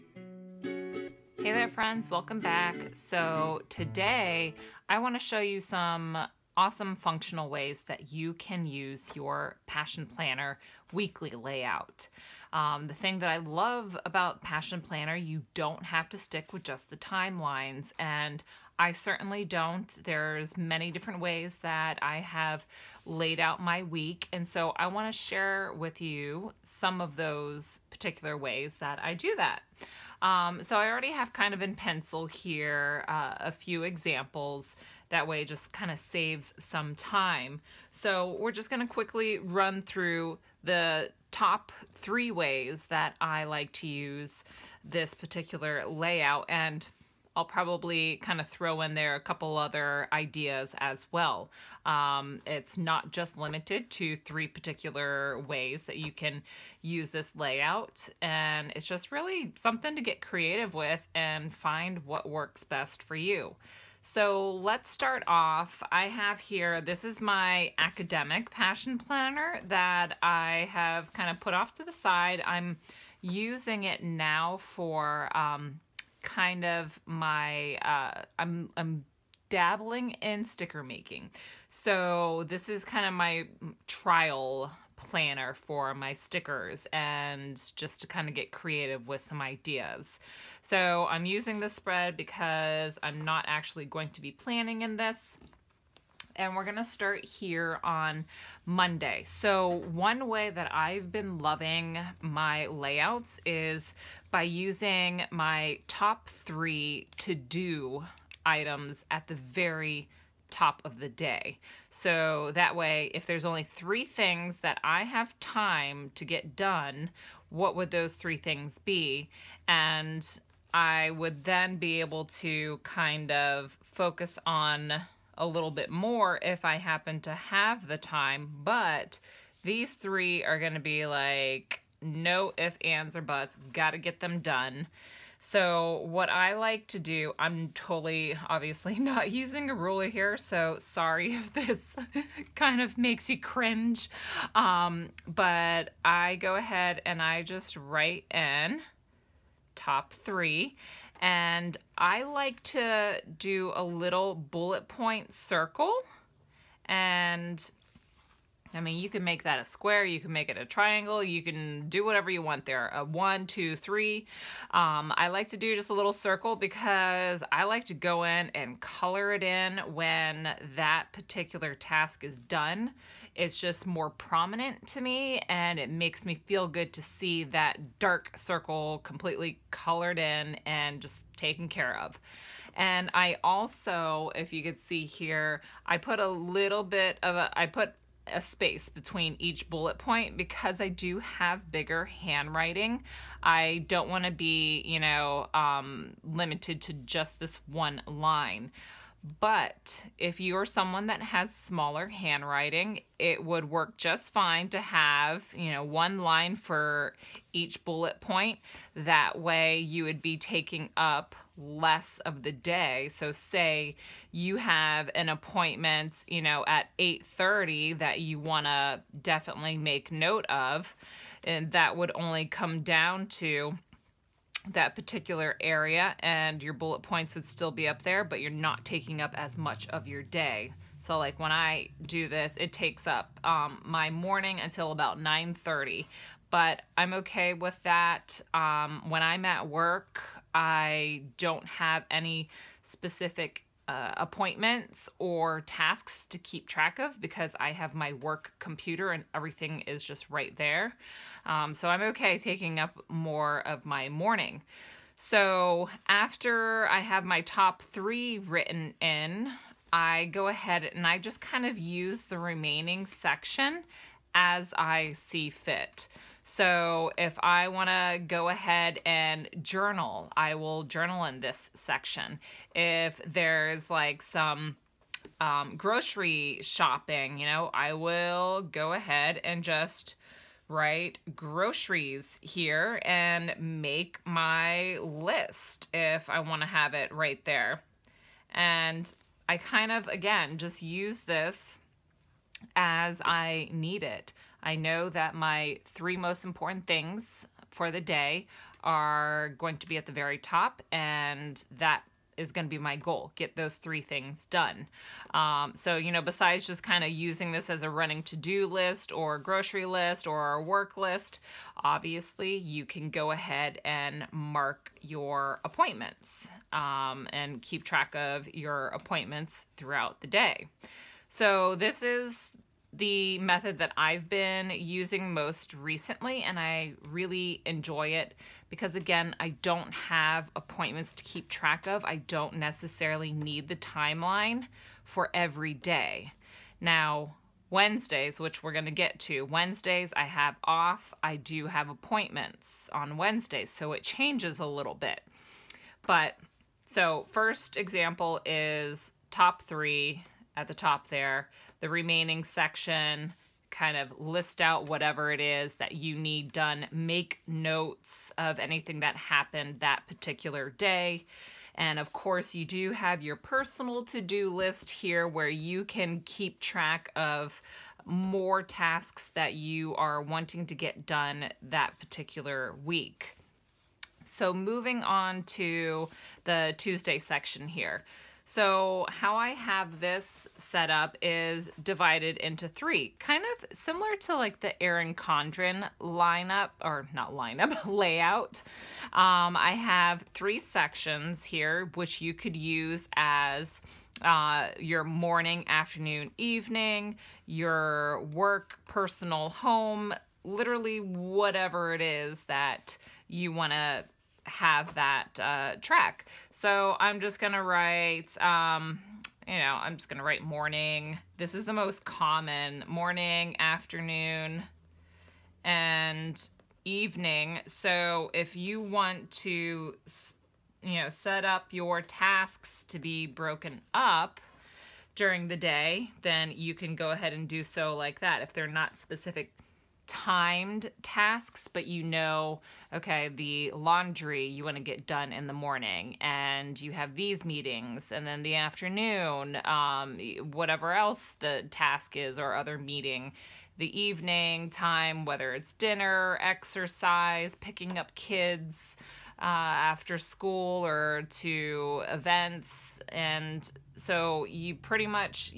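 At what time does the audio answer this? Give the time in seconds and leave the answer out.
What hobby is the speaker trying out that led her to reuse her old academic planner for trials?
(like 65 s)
80 s.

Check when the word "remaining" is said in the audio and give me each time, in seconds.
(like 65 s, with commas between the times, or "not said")
262 s, 351 s.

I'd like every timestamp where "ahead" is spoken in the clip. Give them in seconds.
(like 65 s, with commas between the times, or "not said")
146 s, 260 s, 268 s, 278 s, 313 s, 427 s.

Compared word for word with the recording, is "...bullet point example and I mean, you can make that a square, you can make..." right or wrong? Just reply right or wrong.
wrong.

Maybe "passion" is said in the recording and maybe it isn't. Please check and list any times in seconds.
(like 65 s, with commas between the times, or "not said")
9 s, 14 s, 68 s.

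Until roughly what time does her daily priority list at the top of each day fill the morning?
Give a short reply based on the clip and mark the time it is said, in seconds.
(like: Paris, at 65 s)
9:30, at 235 s.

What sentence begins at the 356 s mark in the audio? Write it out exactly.
Make notes of anything that happened that particular day.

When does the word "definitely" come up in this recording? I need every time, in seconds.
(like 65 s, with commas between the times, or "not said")
219 s.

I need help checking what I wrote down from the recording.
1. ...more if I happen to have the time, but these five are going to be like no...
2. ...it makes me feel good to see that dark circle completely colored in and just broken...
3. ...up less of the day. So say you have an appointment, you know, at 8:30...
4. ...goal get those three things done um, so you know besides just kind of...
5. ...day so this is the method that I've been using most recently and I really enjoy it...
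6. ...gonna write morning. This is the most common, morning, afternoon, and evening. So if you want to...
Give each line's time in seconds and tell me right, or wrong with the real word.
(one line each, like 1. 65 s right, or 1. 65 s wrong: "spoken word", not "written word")
1. 125 s wrong: "three", not "five"
2. 175 s wrong: "taken", not "broken"
3. 210 s right
4. 302 s right
5. 320 s right
6. 410 s right.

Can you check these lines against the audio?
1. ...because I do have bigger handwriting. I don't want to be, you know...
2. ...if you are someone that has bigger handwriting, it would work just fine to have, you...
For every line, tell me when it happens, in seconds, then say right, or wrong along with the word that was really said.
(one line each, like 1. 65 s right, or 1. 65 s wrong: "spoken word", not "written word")
1. 190 s right
2. 200 s wrong: "smaller", not "bigger".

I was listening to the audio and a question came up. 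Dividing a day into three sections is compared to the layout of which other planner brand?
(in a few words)
Erin Condren.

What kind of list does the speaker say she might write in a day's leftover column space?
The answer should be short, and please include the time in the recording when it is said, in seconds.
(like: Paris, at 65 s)
Groceries, at 281 s.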